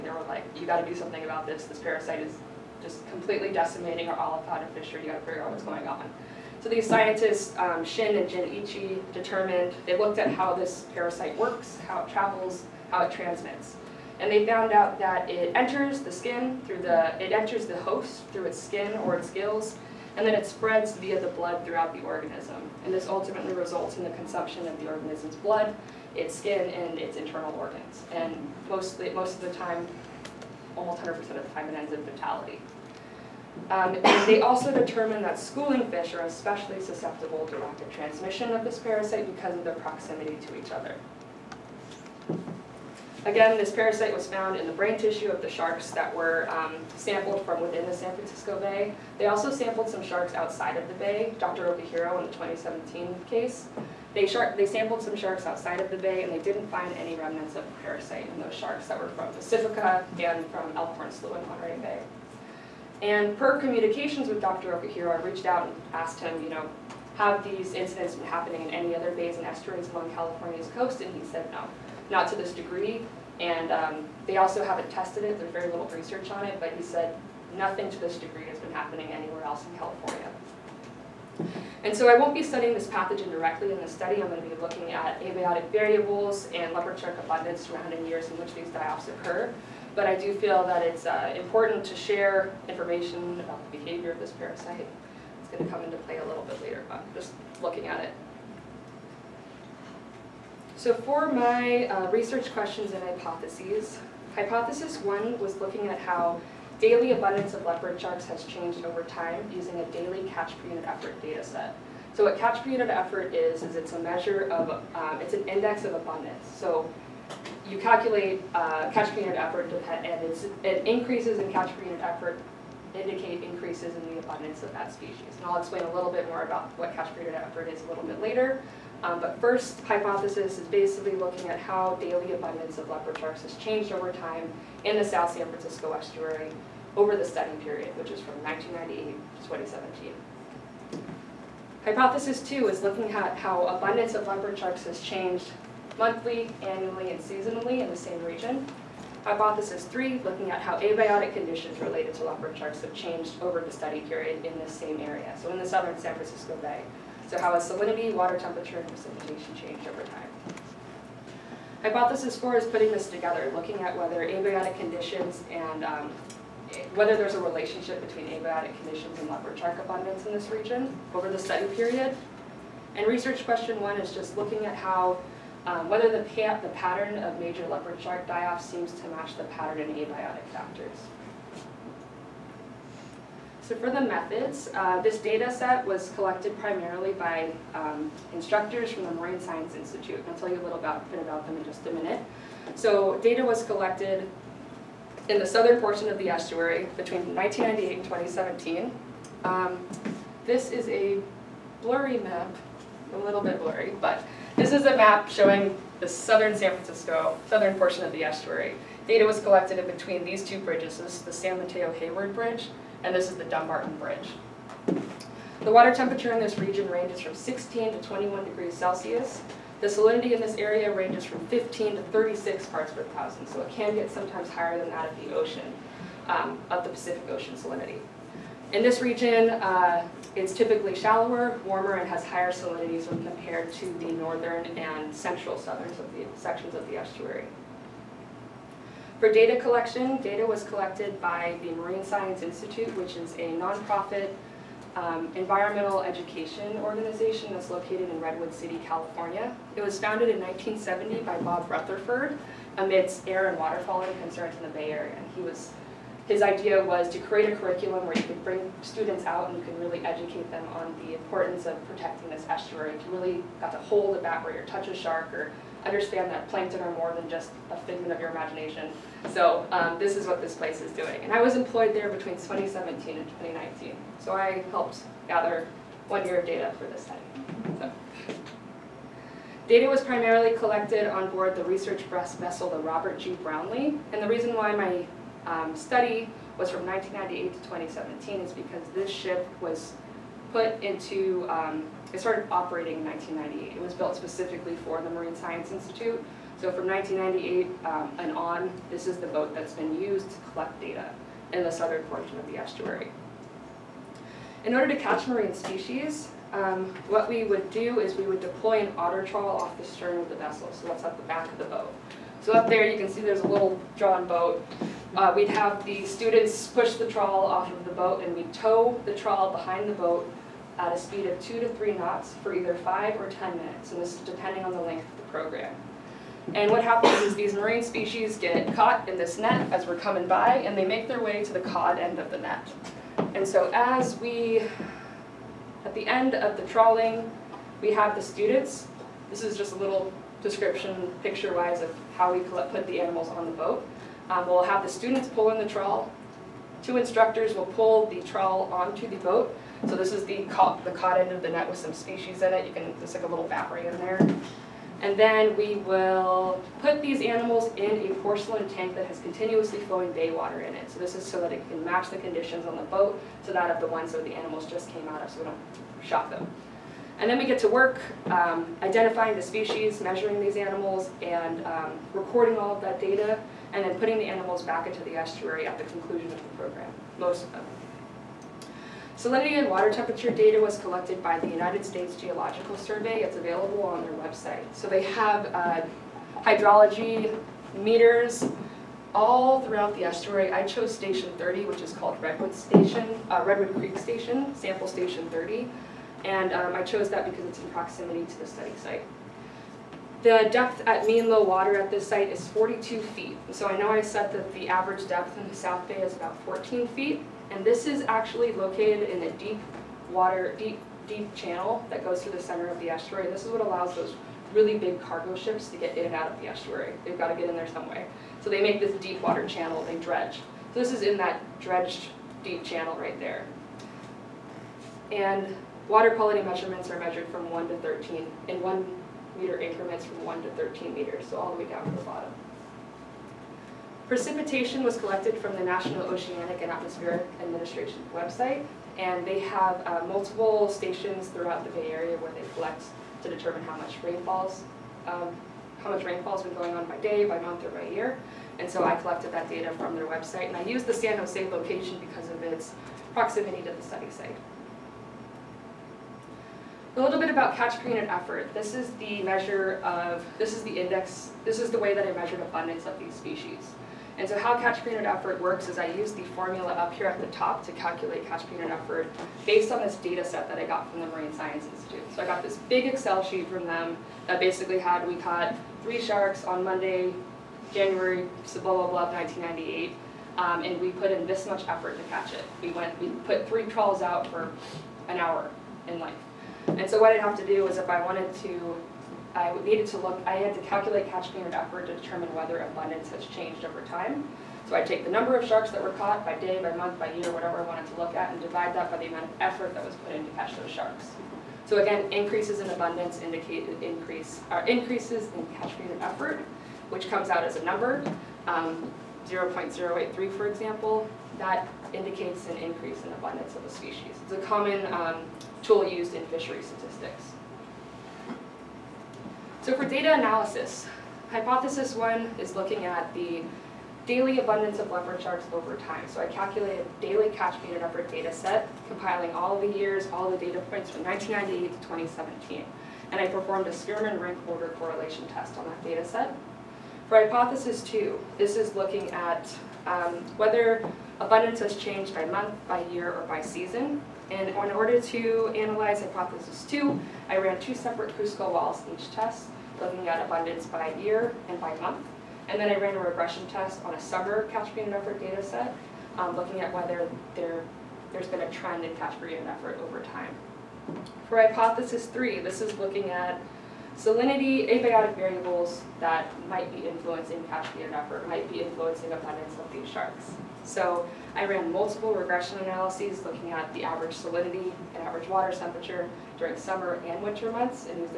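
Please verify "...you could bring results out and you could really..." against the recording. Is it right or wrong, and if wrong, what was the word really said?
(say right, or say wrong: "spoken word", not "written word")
wrong: "students", not "results".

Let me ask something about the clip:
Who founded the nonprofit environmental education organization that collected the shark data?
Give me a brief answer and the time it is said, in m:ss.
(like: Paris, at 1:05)
Bob Rutherford, at 4:11.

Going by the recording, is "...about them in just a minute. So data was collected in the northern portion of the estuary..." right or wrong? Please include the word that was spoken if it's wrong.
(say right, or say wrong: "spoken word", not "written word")
wrong: "southern", not "northern".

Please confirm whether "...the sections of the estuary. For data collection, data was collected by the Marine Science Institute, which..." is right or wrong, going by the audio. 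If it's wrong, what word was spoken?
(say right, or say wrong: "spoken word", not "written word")
right.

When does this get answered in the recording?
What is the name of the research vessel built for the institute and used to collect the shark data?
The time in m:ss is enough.
4:42.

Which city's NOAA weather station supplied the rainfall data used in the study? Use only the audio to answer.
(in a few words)
San Jose.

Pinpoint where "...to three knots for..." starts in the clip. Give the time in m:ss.
5:21.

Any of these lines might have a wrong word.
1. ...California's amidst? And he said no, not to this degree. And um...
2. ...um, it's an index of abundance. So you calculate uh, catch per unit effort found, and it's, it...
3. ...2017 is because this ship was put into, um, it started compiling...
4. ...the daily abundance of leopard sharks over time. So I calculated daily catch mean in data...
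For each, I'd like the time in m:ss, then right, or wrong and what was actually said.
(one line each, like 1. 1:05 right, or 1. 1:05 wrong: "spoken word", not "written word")
1. 1:10 wrong: "coast", not "amidst"
2. 1:54 wrong: "depend", not "found"
3. 4:47 wrong: "operating", not "compiling"
4. 8:43 right.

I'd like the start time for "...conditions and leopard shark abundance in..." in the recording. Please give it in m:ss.
2:48.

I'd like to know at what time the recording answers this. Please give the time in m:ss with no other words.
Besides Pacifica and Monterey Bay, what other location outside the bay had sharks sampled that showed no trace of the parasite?
1:00.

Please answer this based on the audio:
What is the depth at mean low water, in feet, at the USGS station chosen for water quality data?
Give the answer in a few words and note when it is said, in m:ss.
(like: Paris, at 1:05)
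42 feet, at 6:42.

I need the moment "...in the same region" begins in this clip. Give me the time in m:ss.
2:27.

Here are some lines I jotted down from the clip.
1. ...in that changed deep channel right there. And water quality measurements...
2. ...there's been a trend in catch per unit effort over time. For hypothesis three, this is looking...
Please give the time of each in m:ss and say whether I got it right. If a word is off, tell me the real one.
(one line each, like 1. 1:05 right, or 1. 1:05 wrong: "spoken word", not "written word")
1. 7:01 wrong: "dredged", not "changed"
2. 9:18 right.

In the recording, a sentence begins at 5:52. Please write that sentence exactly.
You can, it's like a little battery in there.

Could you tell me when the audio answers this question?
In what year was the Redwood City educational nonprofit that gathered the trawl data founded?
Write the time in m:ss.
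4:10.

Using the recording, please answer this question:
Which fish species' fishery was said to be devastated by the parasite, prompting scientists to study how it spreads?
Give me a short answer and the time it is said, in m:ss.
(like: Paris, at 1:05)
Olive flounder, at 0:04.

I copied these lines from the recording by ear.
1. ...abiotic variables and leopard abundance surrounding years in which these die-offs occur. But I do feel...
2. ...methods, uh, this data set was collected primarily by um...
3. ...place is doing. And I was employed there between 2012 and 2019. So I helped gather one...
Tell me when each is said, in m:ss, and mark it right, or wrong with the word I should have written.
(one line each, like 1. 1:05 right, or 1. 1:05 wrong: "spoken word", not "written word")
1. 1:25 right
2. 3:03 right
3. 4:30 wrong: "2017", not "2012".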